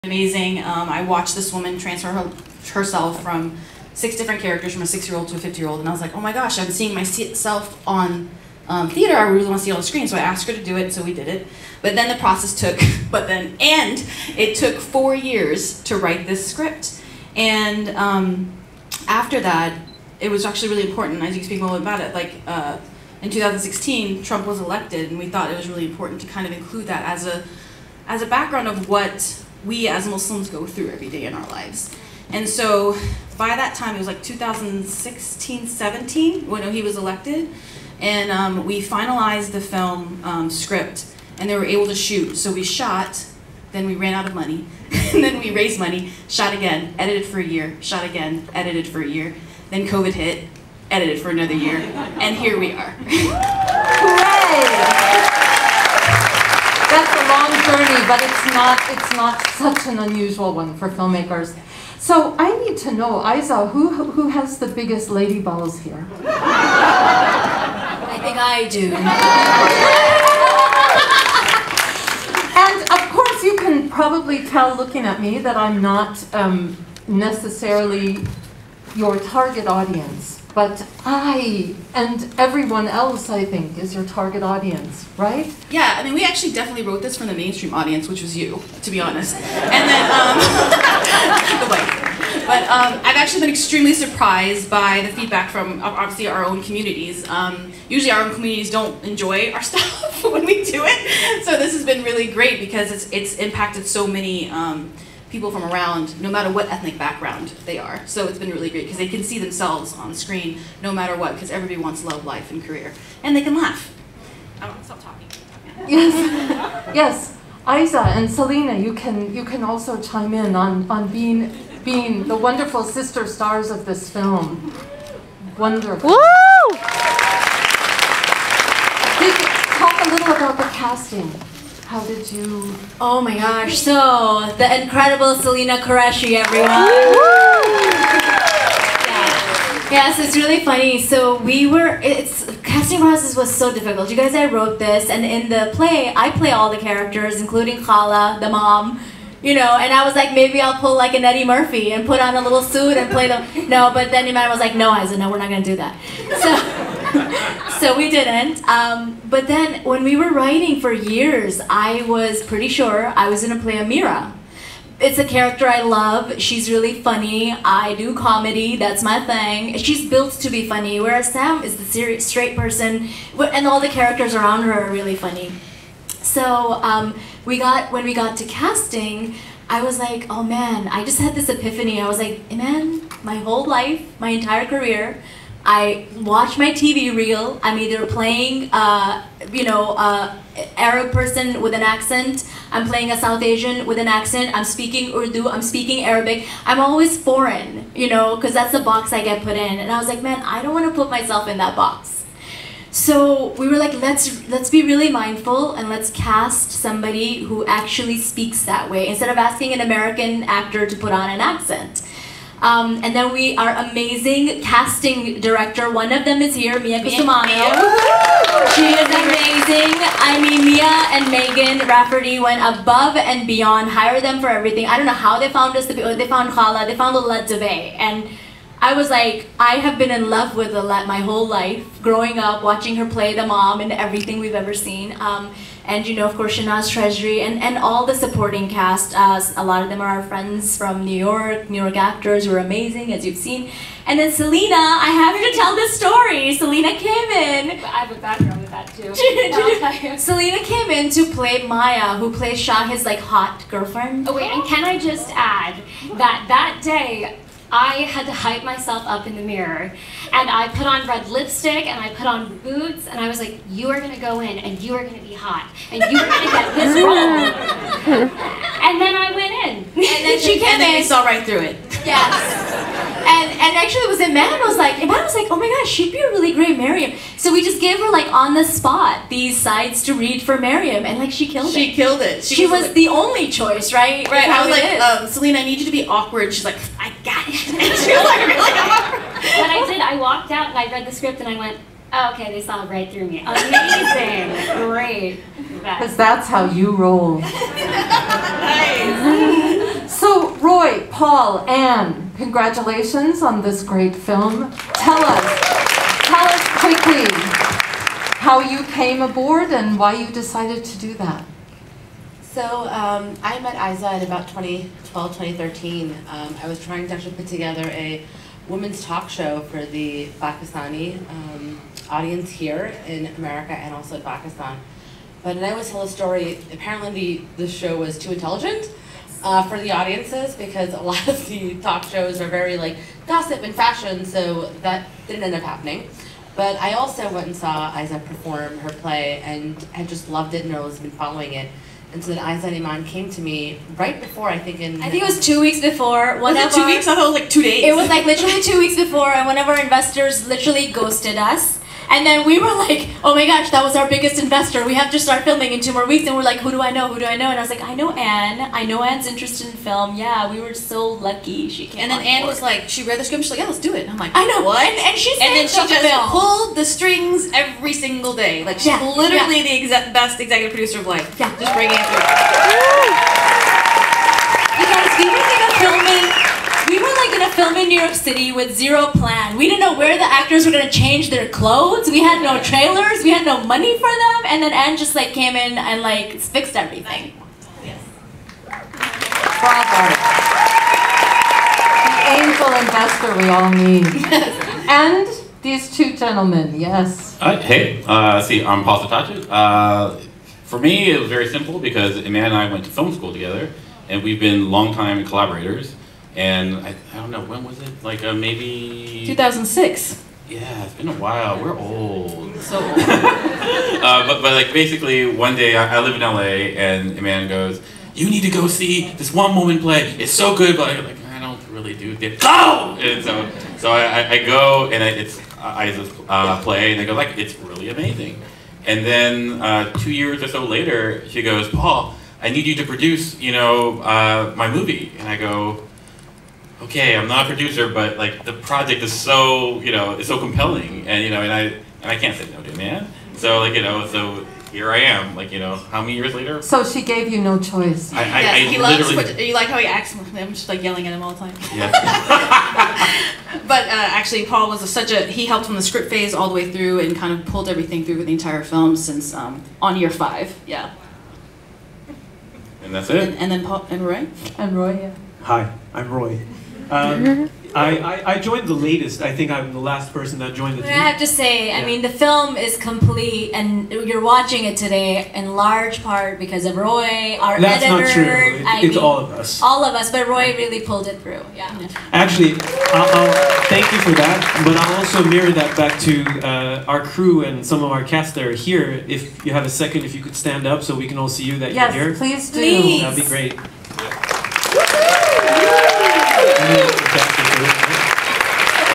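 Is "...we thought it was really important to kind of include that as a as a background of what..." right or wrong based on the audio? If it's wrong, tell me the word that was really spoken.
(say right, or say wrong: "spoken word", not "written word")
right.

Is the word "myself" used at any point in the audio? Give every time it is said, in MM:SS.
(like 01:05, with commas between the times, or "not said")
00:06, 03:21, 04:18.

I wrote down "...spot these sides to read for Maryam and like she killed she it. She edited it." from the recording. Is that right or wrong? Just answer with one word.
wrong.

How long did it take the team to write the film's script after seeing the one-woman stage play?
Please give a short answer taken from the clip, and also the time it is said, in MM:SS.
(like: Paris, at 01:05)
4 years, at 00:14.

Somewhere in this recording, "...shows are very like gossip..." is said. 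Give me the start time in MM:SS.
05:32.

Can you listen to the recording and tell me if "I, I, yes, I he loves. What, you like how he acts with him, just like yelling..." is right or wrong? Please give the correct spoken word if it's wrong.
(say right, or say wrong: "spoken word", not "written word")
right.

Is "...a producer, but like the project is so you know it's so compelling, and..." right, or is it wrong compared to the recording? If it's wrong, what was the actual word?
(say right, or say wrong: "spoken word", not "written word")
right.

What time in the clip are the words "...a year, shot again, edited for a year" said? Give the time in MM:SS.
00:47.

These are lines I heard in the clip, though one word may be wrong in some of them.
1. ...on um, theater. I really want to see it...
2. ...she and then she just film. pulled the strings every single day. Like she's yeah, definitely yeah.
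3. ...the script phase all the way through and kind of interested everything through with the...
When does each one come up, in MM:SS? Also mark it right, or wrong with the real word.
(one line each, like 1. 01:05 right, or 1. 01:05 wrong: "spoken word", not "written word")
1. 00:07 right
2. 06:05 wrong: "literally", not "definitely"
3. 07:35 wrong: "pulled", not "interested".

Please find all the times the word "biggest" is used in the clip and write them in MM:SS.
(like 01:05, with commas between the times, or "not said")
01:04, 05:54.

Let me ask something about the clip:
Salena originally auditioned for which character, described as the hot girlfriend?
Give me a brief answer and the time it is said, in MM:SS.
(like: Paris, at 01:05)
Maya, at 04:11.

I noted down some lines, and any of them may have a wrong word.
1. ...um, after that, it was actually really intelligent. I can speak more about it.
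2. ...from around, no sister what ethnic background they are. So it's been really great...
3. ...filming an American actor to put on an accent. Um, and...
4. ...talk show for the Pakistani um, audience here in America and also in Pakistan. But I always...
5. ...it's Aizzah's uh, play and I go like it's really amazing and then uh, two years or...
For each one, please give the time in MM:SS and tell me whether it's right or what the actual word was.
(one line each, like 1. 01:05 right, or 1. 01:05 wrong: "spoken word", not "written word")
1. 00:17 wrong: "important", not "intelligent"
2. 01:45 wrong: "matter", not "sister"
3. 03:29 wrong: "asking", not "filming"
4. 05:19 right
5. 07:05 right.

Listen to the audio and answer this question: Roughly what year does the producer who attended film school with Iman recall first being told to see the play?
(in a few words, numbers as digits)
2006.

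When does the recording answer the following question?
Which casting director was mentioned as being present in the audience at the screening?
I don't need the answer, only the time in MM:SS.
03:36.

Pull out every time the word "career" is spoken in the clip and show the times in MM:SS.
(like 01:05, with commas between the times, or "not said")
01:52, 03:04.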